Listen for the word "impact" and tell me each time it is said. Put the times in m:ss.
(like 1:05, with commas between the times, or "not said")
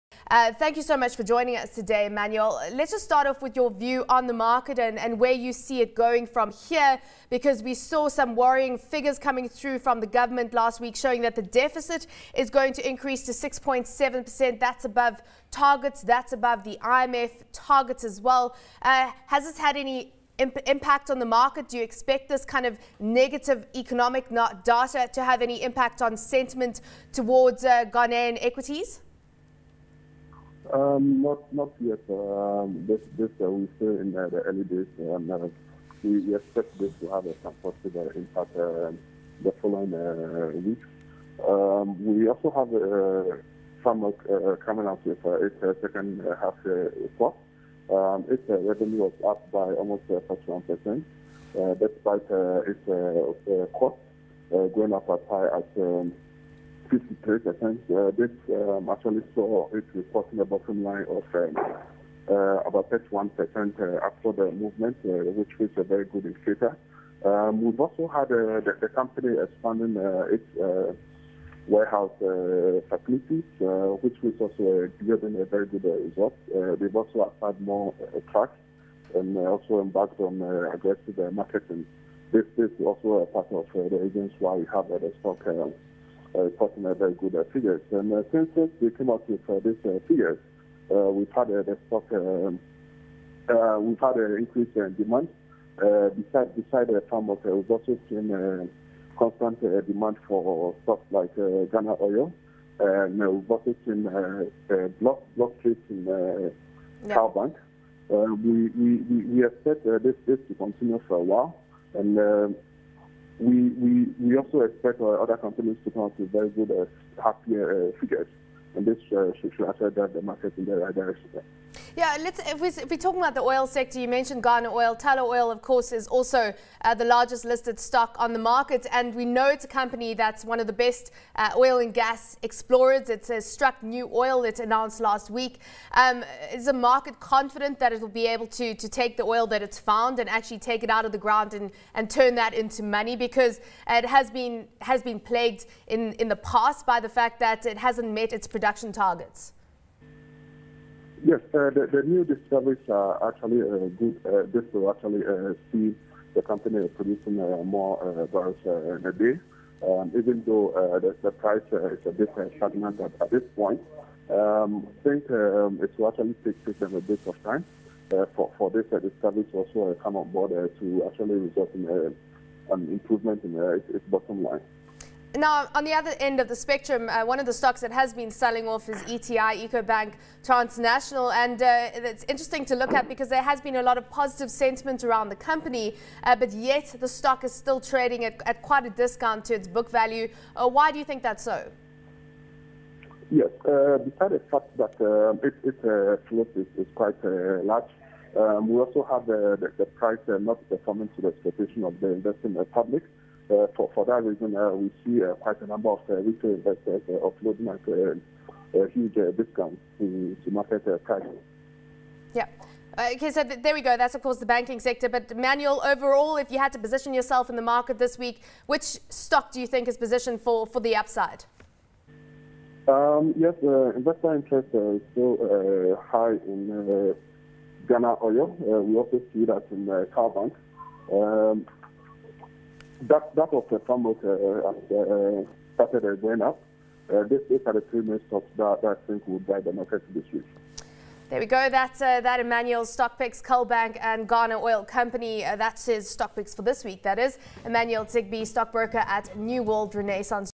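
0:20, 0:25, 0:38.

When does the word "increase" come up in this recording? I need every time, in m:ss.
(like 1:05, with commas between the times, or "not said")
0:12, 1:34.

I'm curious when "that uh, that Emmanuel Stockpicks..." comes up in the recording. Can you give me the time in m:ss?
4:01.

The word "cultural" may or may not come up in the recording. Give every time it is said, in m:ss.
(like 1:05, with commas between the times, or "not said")
not said.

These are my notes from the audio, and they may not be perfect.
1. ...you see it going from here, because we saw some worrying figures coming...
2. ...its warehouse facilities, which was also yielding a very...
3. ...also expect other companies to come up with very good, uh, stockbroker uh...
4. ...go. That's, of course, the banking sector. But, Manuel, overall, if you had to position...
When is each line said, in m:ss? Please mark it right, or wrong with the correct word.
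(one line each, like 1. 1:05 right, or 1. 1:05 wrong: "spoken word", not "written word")
1. 0:05 right
2. 1:10 right
3. 1:54 wrong: "happier", not "stockbroker"
4. 3:33 right.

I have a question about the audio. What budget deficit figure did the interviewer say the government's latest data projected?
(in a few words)
6.7%.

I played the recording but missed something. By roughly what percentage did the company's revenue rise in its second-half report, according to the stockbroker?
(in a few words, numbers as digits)
41 percent.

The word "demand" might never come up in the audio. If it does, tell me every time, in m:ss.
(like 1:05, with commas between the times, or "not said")
1:34, 1:39.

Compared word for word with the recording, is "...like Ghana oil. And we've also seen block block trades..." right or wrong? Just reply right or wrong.
right.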